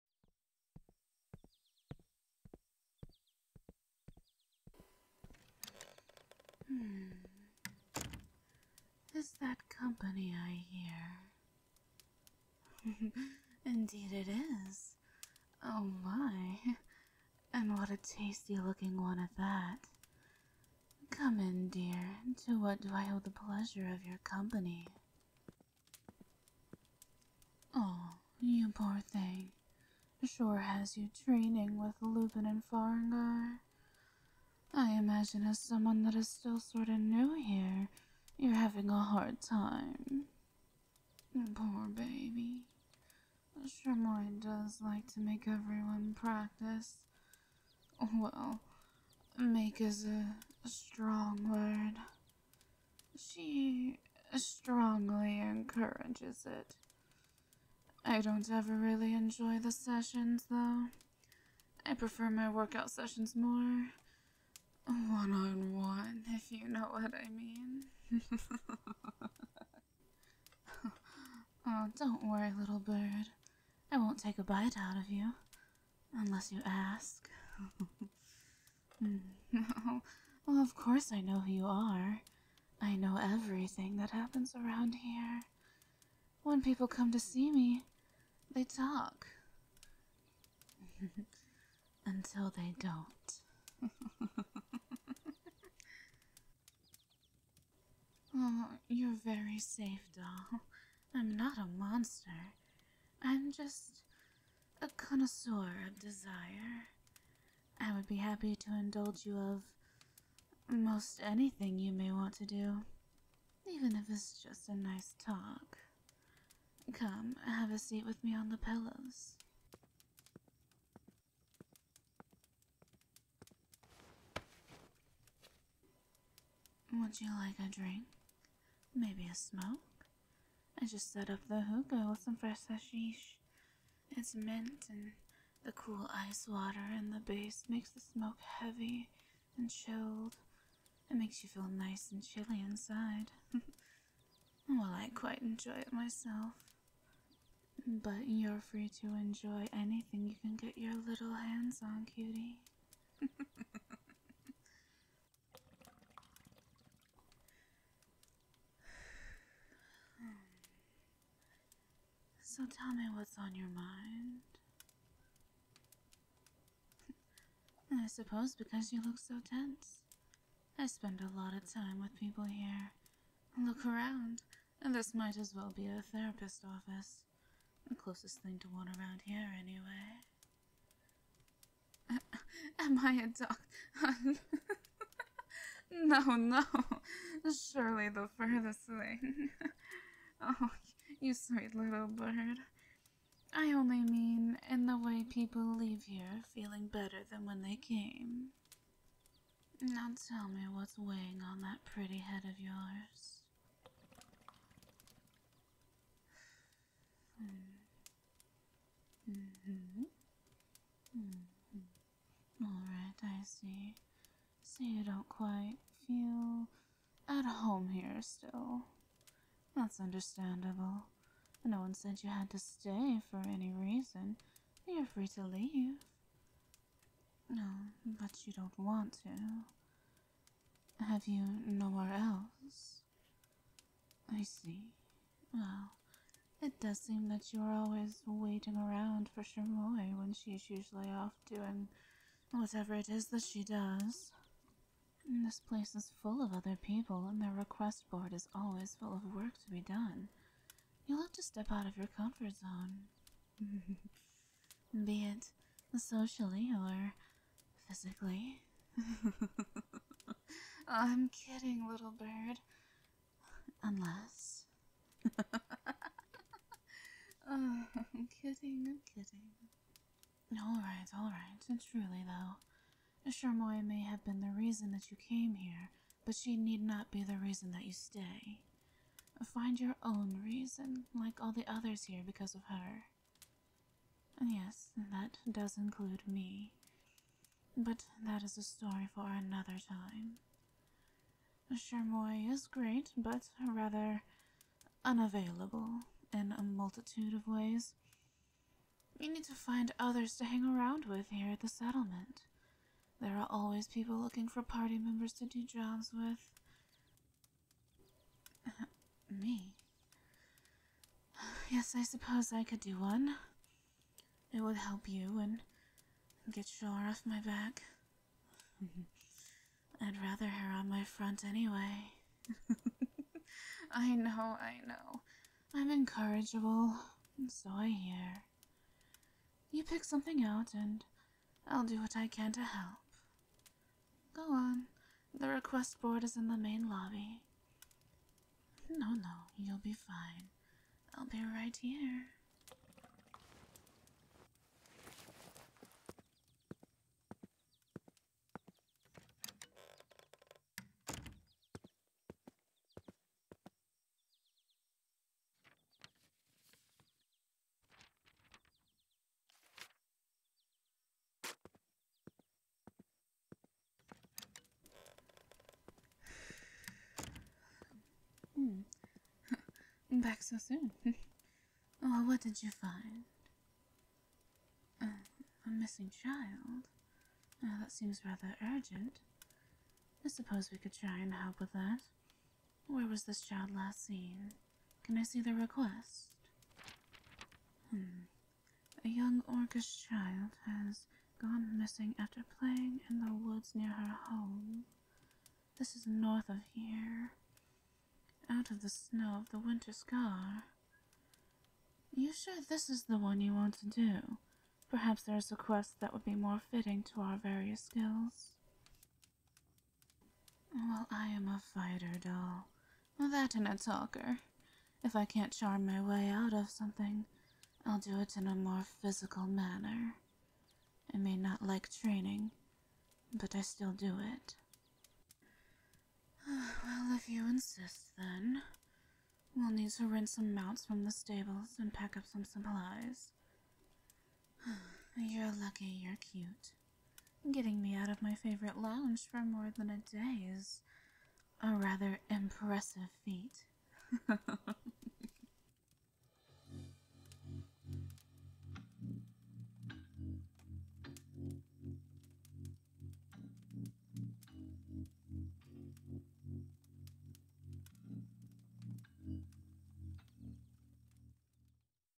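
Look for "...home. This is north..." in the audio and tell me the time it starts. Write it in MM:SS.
06:34.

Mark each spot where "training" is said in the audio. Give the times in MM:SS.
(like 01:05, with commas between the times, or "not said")
00:31, 07:01.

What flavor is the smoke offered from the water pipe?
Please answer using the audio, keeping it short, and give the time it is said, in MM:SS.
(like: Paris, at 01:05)
mint, at 02:14.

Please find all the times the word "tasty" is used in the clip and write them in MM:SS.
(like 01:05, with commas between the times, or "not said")
00:17.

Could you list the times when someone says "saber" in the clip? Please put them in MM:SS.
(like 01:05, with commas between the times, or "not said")
not said.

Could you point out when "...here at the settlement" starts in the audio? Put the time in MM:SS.
05:01.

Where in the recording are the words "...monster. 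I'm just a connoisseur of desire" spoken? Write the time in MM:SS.
01:41.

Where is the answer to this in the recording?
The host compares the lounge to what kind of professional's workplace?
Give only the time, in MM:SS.
02:56.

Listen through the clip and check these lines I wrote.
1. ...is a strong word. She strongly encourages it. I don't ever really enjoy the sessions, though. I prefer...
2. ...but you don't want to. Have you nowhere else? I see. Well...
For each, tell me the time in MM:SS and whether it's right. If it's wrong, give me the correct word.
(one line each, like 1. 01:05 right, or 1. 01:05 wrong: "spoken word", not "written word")
1. 00:49 right
2. 03:48 right.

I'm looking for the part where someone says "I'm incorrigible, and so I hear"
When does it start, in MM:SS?
05:25.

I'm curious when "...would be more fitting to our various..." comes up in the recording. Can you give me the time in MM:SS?
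06:46.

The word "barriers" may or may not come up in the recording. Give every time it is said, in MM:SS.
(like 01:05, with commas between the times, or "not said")
not said.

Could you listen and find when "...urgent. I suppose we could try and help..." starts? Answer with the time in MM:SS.
06:18.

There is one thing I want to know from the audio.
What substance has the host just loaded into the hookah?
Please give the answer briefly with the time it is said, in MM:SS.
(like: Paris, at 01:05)
hashish, at 02:12.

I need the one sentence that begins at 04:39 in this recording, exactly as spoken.
Find your own reason, like all the others here, because of her.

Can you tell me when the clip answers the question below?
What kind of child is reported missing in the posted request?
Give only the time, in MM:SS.
06:29.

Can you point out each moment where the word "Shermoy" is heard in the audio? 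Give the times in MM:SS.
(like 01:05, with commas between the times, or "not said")
00:43, 04:33, 04:51.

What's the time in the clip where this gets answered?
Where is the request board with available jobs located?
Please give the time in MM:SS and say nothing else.
05:36.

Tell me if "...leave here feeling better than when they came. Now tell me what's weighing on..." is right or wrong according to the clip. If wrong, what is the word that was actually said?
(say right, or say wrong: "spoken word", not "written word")
right.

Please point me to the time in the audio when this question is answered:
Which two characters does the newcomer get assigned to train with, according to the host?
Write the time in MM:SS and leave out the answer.
00:32.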